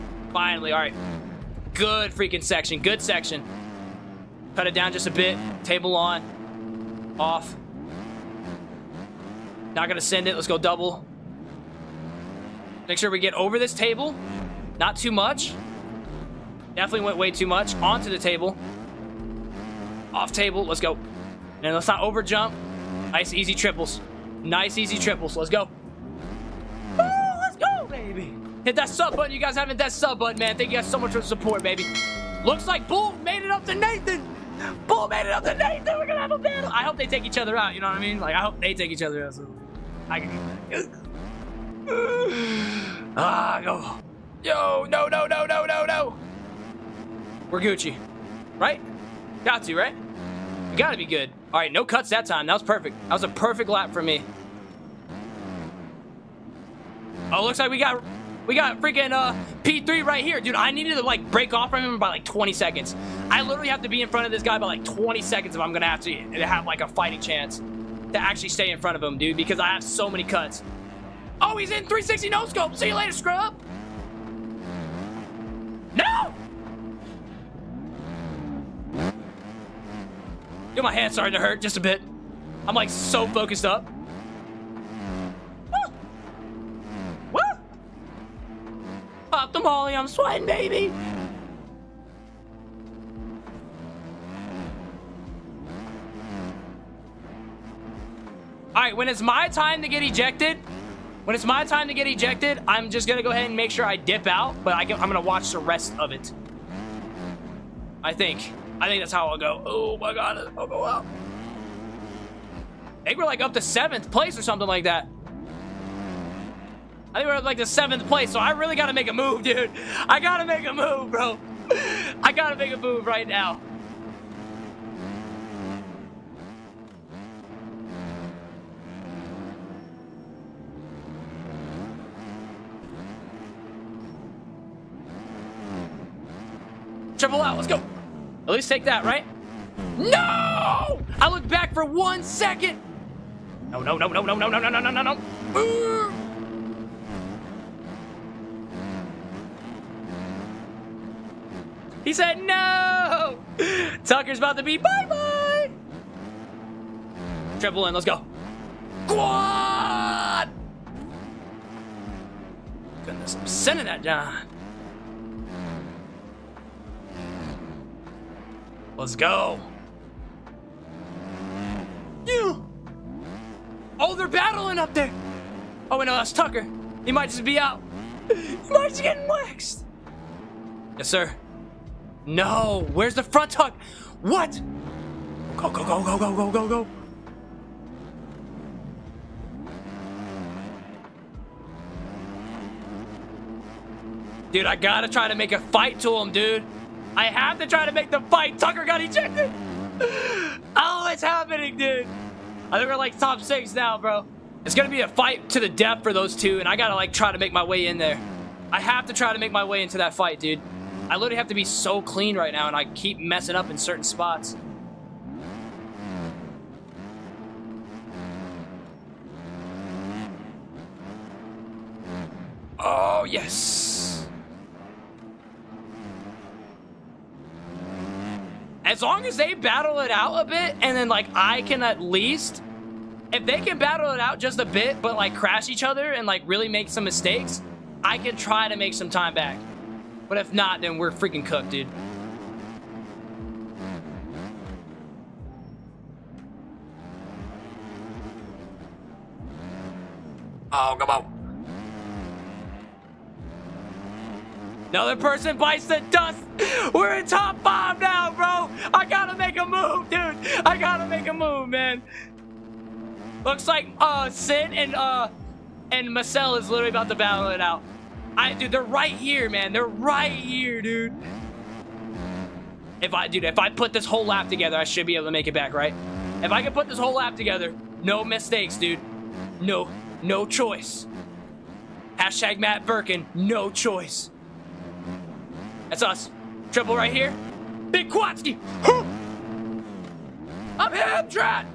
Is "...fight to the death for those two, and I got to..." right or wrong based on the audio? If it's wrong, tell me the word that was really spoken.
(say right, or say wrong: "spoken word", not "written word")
right.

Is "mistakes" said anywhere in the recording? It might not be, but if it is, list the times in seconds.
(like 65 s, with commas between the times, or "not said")
237 s, 278 s.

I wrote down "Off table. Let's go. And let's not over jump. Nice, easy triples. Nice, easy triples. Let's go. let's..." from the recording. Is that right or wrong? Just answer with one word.
right.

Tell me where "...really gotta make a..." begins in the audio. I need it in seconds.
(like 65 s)
118 s.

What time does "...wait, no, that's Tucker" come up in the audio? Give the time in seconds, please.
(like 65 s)
175 s.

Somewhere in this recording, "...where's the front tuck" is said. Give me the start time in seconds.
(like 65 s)
182 s.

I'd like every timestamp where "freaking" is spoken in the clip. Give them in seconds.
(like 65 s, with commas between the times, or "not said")
2 s, 58 s, 241 s.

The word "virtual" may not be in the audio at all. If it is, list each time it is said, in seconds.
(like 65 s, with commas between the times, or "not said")
not said.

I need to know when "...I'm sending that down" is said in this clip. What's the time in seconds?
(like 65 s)
163 s.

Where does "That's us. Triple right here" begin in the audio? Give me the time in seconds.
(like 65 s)
285 s.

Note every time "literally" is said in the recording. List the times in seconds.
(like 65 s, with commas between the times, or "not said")
63 s, 211 s, 266 s.